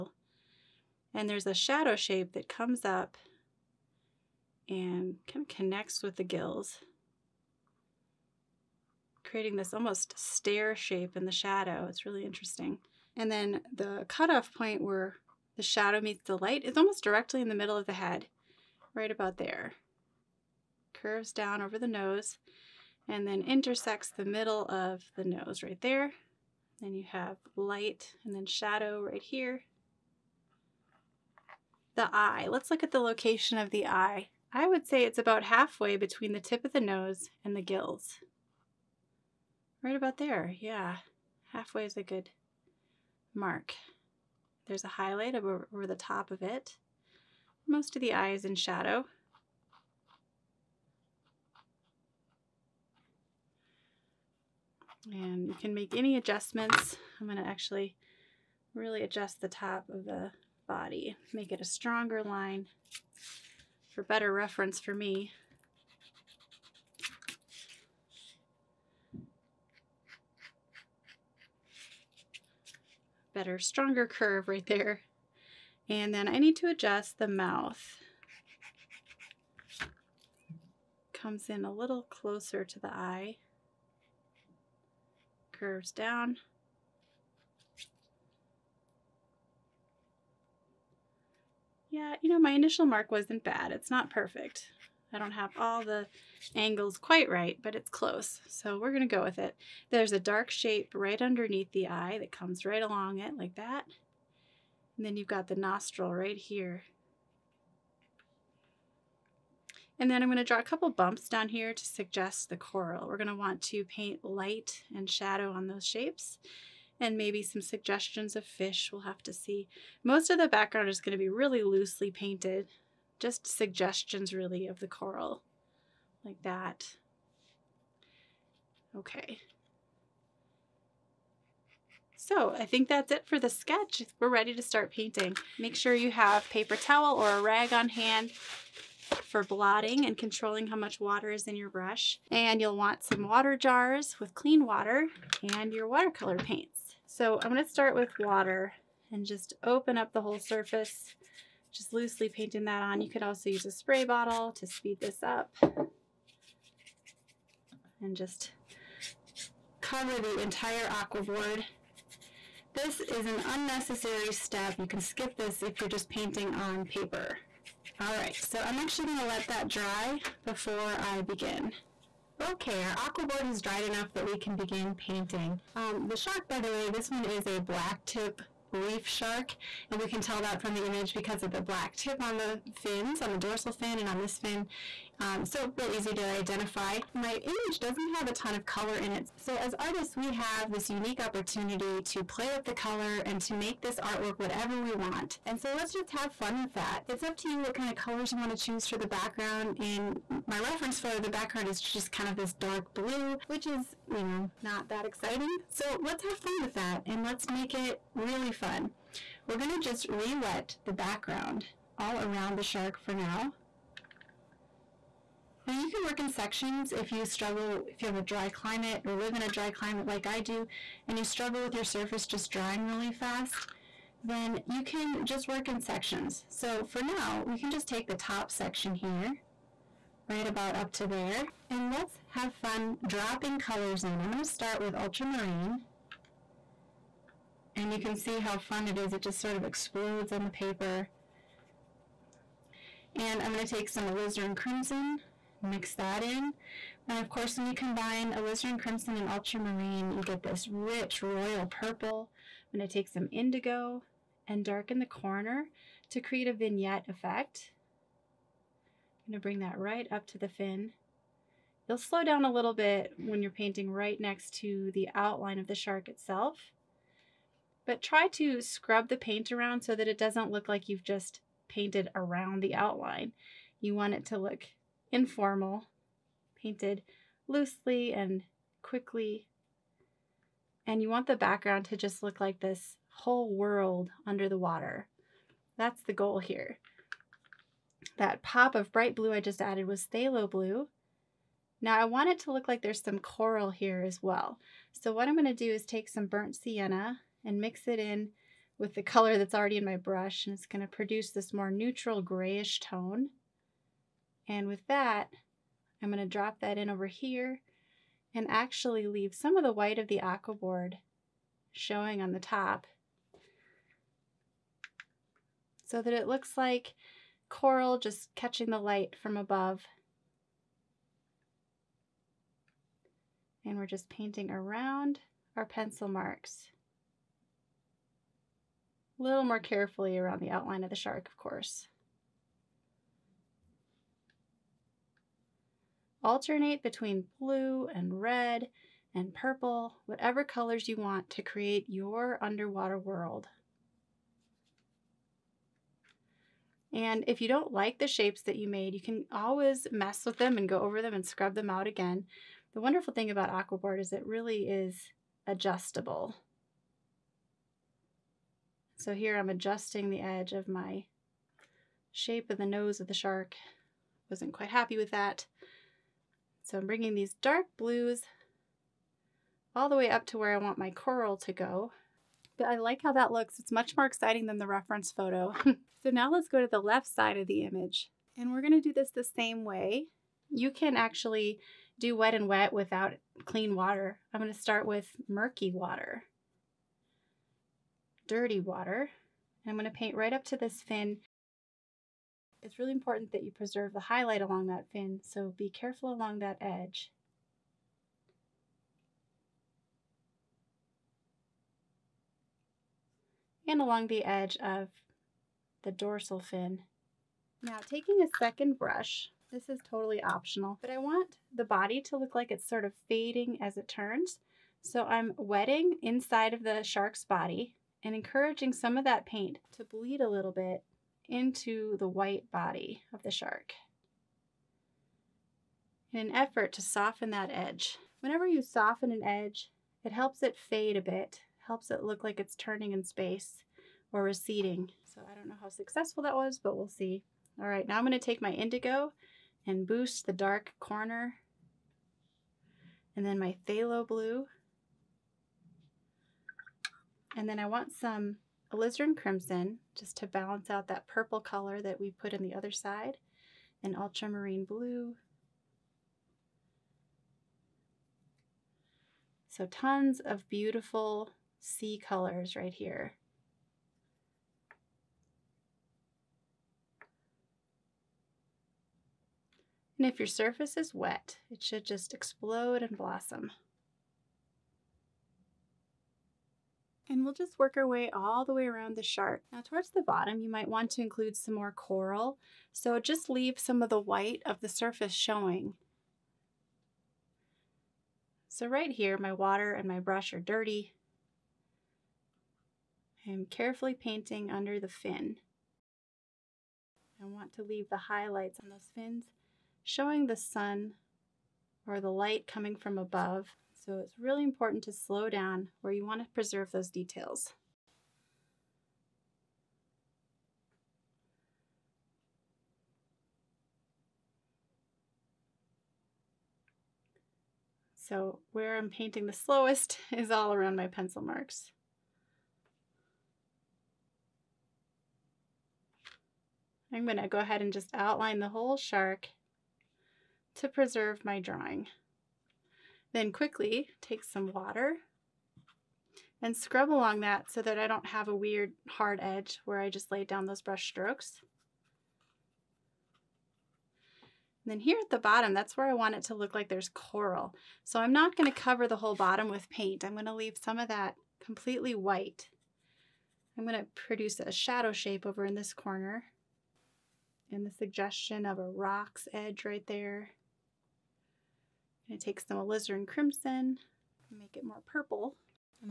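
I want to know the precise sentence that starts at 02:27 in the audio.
So I'm going to start with water and just open up the whole surface, just loosely painting that on.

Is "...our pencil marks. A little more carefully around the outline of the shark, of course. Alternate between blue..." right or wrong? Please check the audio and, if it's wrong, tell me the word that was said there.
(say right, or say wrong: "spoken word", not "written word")
right.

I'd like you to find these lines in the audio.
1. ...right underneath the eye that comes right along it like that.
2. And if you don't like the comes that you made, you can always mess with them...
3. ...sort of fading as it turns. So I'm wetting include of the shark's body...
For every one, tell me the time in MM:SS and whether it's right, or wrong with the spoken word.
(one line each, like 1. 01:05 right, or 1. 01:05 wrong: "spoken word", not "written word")
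1. 01:40 right
2. 05:46 wrong: "shapes", not "comes"
3. 06:52 wrong: "inside", not "include".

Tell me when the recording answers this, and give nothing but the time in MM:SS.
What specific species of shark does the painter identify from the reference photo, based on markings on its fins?
02:57.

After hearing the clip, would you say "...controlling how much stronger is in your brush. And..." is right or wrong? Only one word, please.
wrong.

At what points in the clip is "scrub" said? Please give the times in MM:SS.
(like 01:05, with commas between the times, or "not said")
04:28, 05:51, 08:56.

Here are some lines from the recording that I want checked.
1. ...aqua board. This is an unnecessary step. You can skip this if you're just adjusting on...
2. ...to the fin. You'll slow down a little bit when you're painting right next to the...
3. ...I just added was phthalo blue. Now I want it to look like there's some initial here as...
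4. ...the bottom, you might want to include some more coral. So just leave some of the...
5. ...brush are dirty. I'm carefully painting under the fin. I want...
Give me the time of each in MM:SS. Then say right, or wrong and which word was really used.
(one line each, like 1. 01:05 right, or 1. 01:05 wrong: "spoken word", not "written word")
1. 02:40 wrong: "painting", not "adjusting"
2. 04:20 right
3. 04:49 wrong: "coral", not "initial"
4. 07:59 right
5. 08:09 right.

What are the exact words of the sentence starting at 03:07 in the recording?
My image doesn't have a ton of color in it.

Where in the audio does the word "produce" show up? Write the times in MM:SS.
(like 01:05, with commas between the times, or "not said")
05:00, 09:13.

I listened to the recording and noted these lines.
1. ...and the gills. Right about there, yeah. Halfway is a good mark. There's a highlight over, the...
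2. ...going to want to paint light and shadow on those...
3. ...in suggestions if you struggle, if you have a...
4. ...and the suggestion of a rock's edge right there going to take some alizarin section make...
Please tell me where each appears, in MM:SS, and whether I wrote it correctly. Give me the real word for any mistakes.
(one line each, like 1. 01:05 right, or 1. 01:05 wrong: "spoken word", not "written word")
1. 00:37 right
2. 01:53 right
3. 03:36 wrong: "sections", not "suggestions"
4. 09:17 wrong: "crimson", not "section".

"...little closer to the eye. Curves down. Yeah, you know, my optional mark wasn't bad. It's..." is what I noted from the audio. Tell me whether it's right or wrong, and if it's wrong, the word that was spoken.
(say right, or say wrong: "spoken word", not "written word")
wrong: "initial", not "optional".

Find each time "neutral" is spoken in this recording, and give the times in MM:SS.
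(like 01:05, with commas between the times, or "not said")
05:01.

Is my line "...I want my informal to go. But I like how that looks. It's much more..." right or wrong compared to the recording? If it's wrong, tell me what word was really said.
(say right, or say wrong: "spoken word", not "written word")
wrong: "coral", not "informal".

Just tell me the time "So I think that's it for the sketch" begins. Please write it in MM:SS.
02:12.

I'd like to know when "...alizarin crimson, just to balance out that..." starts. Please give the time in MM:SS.
07:28.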